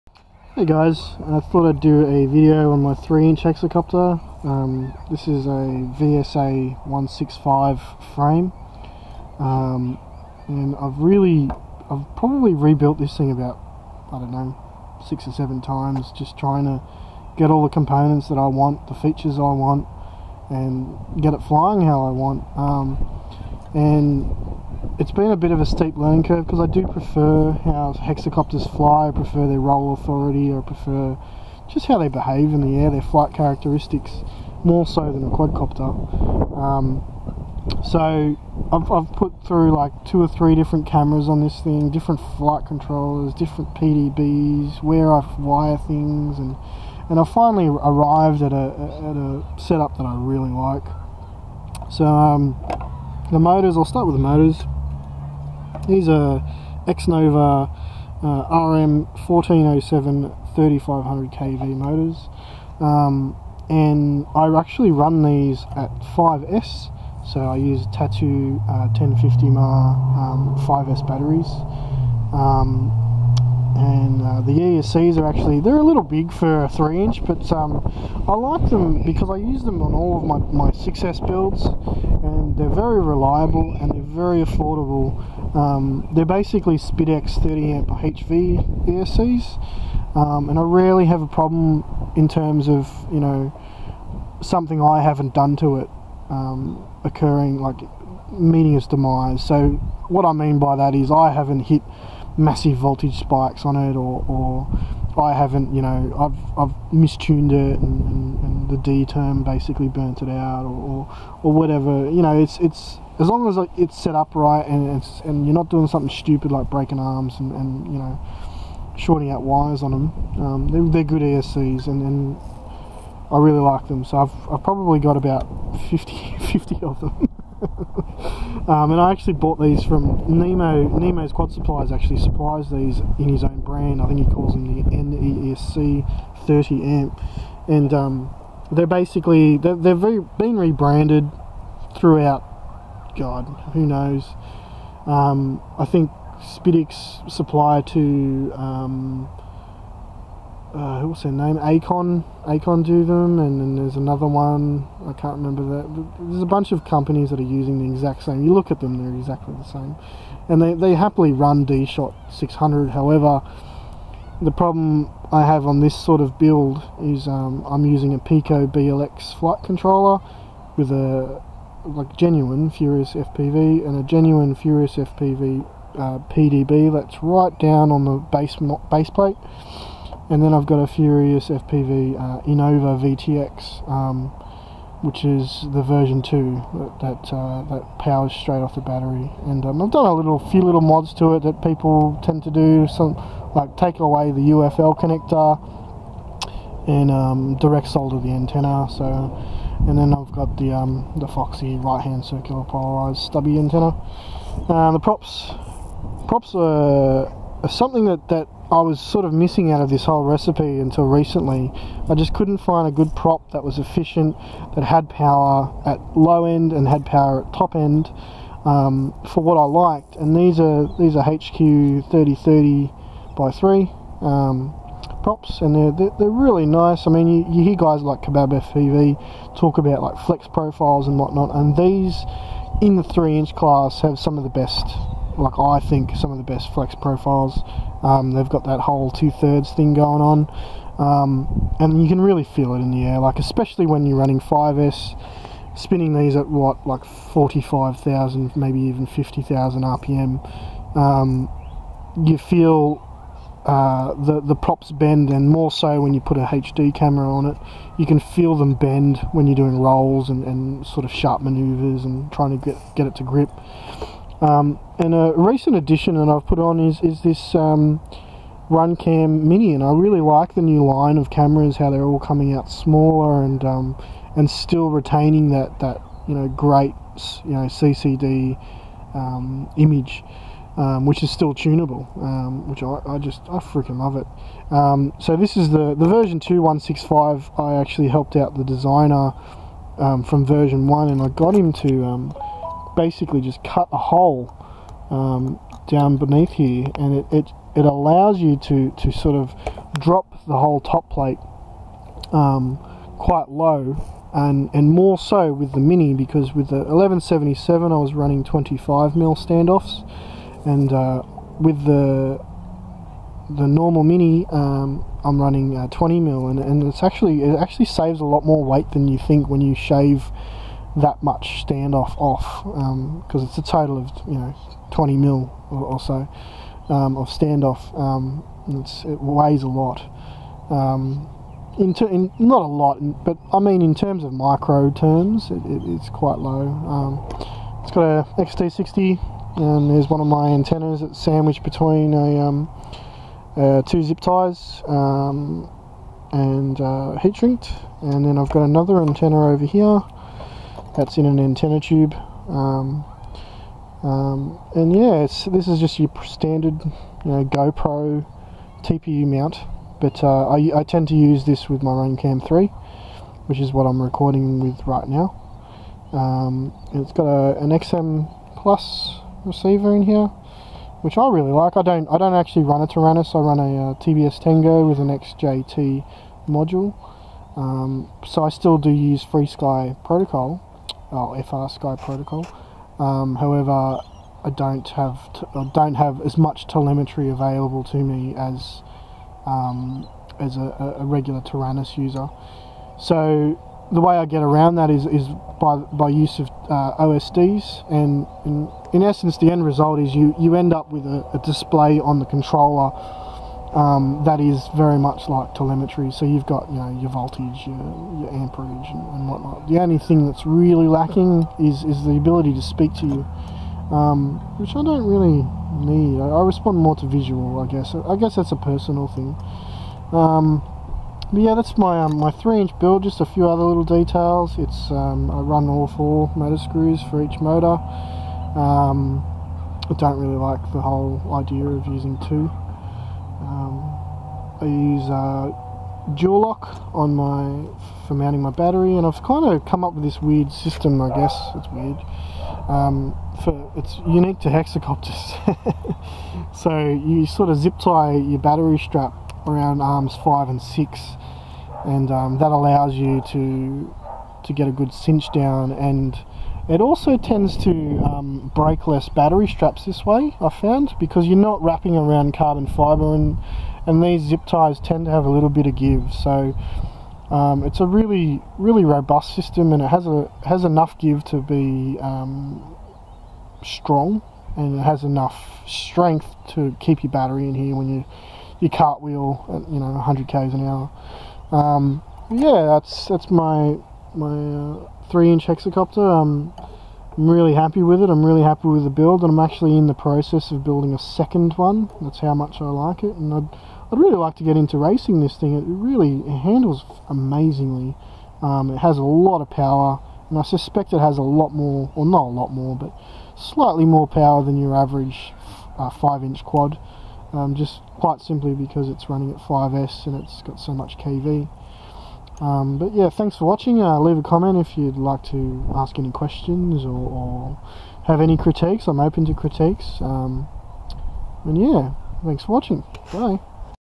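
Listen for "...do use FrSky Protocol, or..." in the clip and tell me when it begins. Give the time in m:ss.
6:18.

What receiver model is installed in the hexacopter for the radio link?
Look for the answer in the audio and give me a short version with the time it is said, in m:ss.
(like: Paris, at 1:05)
XM plus, at 6:07.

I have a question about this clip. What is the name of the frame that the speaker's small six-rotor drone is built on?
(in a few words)
VSA 165.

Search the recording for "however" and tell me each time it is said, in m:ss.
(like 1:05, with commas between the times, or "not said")
2:42, 6:23.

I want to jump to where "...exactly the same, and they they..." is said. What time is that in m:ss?
2:39.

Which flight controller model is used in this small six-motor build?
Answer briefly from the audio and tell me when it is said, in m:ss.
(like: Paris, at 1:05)
Piko BLX, at 2:48.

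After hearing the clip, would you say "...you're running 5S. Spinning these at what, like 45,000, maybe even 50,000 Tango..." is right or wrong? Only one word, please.
wrong.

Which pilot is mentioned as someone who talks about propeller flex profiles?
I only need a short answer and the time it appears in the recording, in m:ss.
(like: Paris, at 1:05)
Kabab FPV, at 3:48.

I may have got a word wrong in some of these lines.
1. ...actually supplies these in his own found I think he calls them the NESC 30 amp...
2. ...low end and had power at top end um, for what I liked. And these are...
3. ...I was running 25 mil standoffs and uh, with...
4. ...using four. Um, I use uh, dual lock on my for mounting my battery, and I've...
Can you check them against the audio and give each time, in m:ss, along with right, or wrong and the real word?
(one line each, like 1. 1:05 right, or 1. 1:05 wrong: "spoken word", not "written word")
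1. 2:11 wrong: "brand", not "found"
2. 3:36 right
3. 5:07 right
4. 7:11 wrong: "two", not "four".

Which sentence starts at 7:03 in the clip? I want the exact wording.
Just a few other little details.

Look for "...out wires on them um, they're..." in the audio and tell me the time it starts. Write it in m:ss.
1:59.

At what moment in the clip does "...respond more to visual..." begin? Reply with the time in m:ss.
6:56.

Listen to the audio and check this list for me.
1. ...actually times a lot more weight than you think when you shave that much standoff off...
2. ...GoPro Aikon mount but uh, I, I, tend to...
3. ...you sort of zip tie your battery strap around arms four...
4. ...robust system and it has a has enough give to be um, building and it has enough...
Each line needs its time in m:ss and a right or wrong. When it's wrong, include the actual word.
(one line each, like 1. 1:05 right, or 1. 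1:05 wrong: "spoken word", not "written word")
1. 5:17 wrong: "saves", not "times"
2. 5:57 wrong: "TPU", not "Aikon"
3. 7:26 wrong: "five", not "four"
4. 7:48 wrong: "strong", not "building".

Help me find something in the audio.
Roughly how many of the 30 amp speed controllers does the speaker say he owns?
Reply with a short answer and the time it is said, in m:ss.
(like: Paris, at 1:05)
50, at 2:05.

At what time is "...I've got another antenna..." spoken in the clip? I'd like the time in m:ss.
5:48.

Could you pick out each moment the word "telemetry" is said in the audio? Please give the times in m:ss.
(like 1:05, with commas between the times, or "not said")
6:26, 6:45.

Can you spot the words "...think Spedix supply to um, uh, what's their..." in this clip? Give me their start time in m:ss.
2:25.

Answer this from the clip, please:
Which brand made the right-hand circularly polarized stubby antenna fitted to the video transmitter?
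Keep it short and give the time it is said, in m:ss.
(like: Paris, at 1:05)
Foxeer, at 3:21.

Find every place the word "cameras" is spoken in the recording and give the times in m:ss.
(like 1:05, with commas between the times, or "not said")
0:40, 4:16, 4:31.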